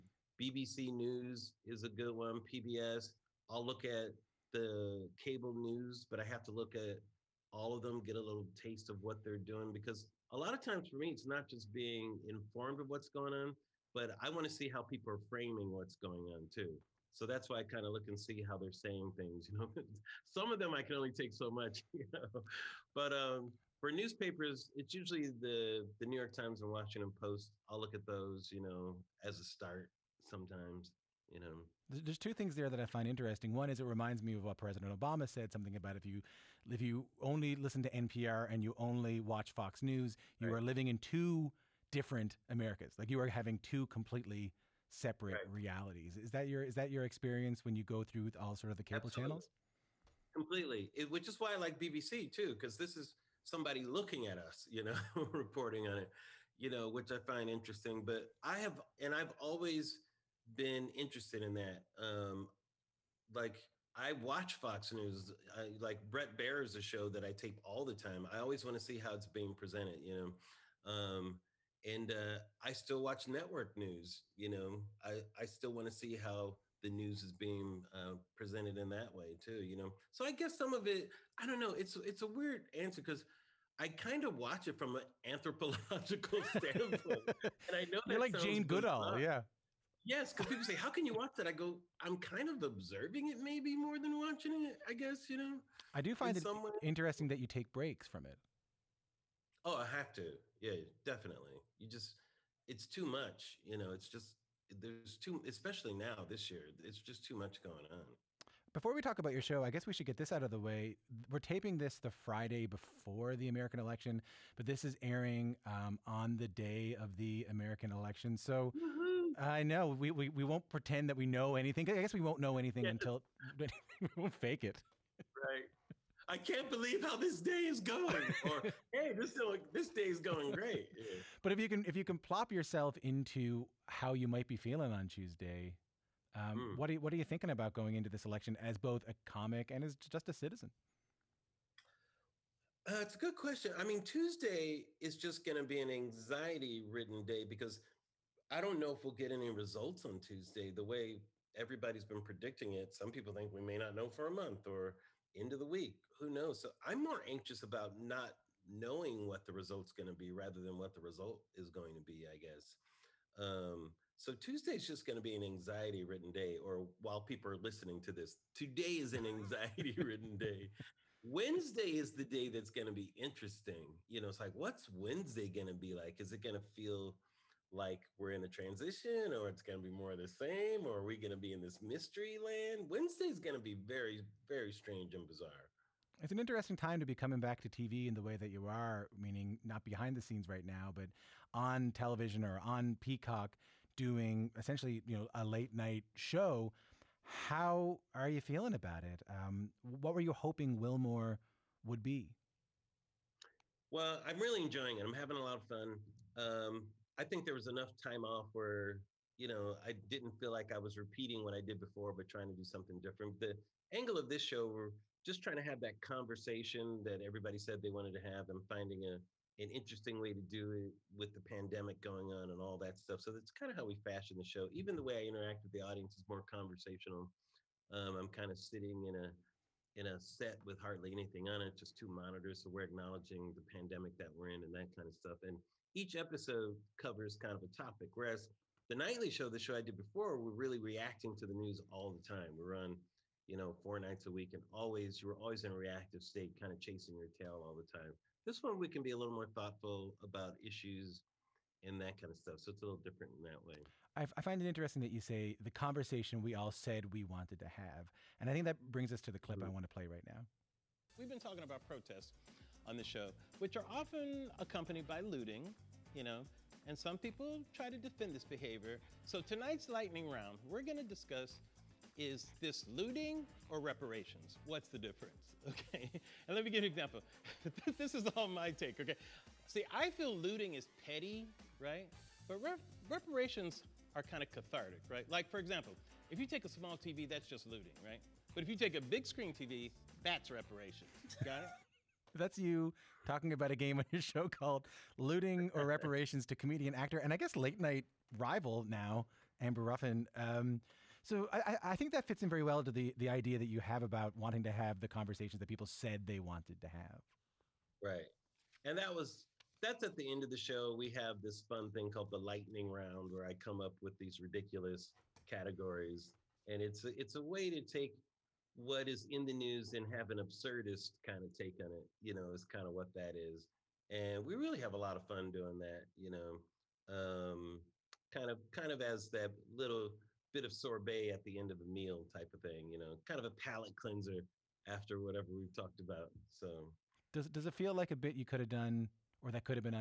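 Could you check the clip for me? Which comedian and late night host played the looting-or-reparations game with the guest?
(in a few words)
Amber Ruffin.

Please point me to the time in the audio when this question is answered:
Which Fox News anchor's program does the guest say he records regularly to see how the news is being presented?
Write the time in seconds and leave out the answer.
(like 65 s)
66 s.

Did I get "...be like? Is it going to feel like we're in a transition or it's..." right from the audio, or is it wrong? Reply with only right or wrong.
right.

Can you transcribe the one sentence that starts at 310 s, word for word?
We have this fun thing called the lightning round where I come up with these ridiculous categories.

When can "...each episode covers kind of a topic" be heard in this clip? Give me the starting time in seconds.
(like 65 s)
235 s.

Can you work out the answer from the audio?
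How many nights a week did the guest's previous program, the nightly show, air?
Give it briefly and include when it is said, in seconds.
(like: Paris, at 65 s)
4, at 243 s.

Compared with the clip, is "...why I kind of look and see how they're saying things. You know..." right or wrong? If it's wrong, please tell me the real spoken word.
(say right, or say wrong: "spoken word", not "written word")
right.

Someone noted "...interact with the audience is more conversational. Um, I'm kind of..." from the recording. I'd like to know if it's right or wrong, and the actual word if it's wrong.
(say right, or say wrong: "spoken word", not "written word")
right.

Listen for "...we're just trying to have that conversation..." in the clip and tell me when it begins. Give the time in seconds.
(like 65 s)
214 s.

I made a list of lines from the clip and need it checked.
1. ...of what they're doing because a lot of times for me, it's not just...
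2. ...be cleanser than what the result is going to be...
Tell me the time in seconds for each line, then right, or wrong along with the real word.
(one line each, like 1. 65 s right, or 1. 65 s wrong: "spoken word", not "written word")
1. 8 s right
2. 160 s wrong: "rather", not "cleanser".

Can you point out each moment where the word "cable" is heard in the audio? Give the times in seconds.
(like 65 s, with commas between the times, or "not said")
5 s, 48 s.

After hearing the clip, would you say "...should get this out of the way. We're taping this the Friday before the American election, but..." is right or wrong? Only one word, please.
right.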